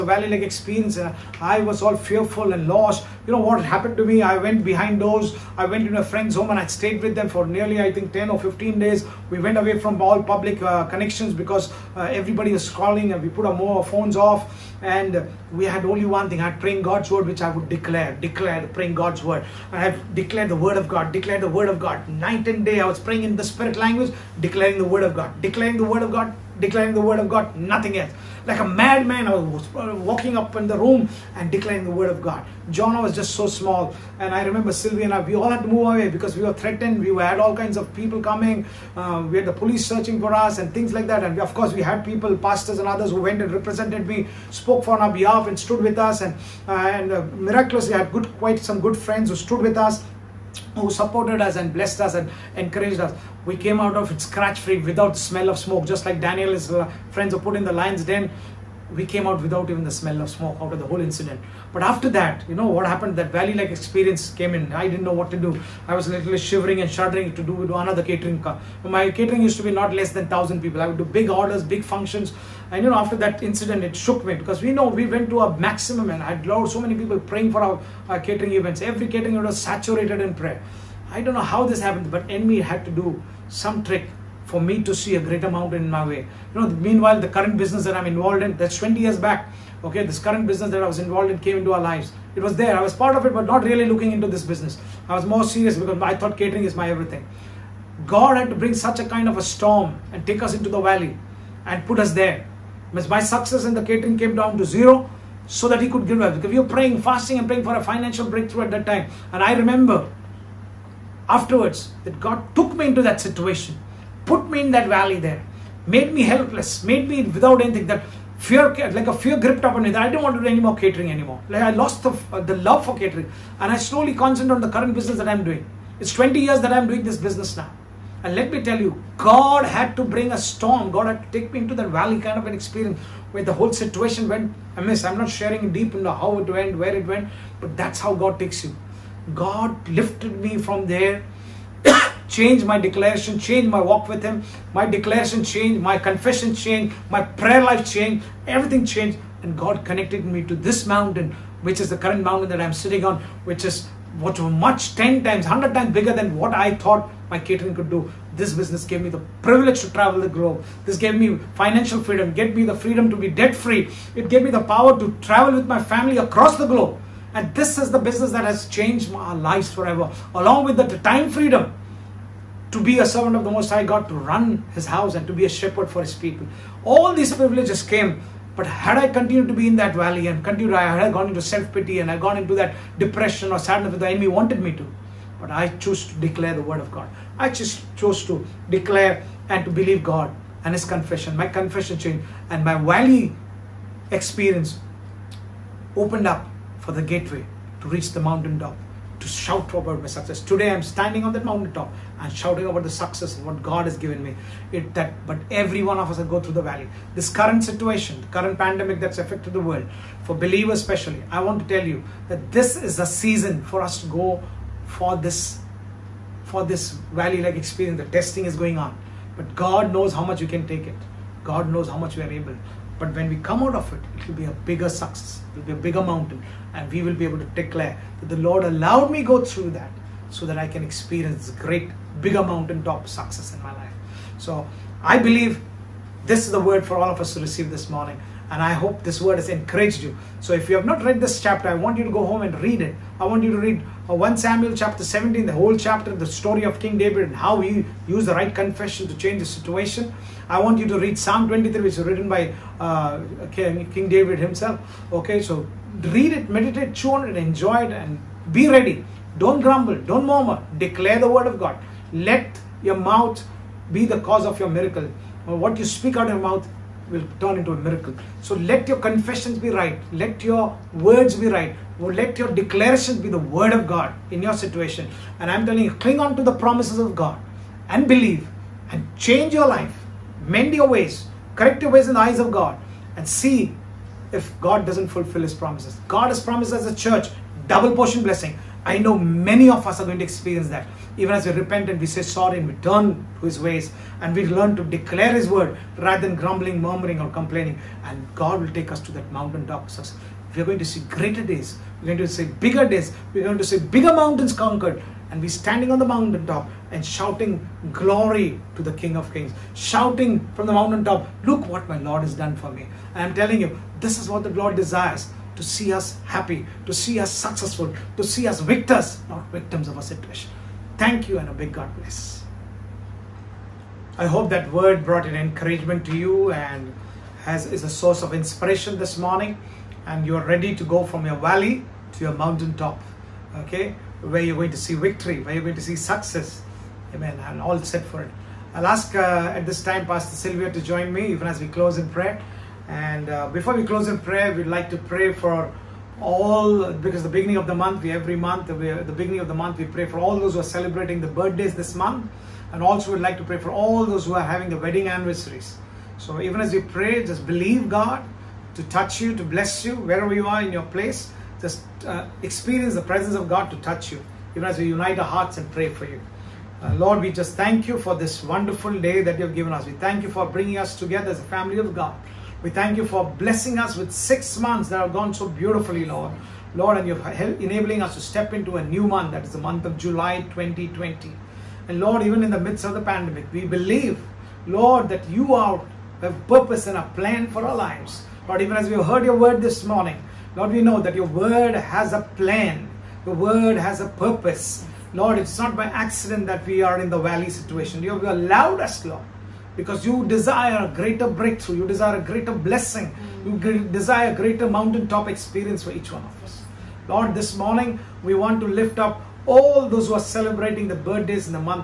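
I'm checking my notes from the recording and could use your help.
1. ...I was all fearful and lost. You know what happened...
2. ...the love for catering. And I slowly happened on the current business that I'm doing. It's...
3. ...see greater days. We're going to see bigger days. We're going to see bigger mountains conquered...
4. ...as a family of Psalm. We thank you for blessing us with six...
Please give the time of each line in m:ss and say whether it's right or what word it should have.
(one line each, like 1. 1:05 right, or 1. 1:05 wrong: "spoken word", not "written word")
1. 0:01 right
2. 2:02 wrong: "concentrated", not "happened"
3. 5:00 right
4. 6:11 wrong: "God", not "Psalm".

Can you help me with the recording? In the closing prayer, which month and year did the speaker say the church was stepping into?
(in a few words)
July 2020.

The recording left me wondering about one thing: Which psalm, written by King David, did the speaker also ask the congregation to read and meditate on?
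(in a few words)
Psalm 23.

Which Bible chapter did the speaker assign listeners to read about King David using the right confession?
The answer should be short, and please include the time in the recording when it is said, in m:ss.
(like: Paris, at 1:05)
1 Samuel 17, at 4:04.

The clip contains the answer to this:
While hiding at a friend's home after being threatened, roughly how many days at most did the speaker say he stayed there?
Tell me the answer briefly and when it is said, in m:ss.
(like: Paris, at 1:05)
15, at 0:08.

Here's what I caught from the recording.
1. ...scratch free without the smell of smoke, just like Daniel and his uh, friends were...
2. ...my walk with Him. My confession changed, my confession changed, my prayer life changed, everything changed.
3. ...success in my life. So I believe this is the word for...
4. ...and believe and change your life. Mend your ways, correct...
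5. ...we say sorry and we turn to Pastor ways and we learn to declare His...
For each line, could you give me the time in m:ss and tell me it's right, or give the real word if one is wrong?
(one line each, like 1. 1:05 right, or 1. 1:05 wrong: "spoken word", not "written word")
1. 0:54 right
2. 2:23 wrong: "declaration", not "confession"
3. 3:53 right
4. 4:37 right
5. 4:51 wrong: "His", not "Pastor".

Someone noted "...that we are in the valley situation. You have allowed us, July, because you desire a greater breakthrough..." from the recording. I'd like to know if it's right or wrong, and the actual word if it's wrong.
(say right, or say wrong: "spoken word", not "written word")
wrong: "Lord", not "July".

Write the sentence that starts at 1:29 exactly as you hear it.
Okay, this current business that I was involved in came into our lives.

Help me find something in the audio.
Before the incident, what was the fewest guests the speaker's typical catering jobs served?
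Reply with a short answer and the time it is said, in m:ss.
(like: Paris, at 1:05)
1,000, at 1:10.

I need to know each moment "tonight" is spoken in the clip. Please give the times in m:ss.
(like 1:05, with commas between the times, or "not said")
not said.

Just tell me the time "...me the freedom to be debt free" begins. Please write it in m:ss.
2:42.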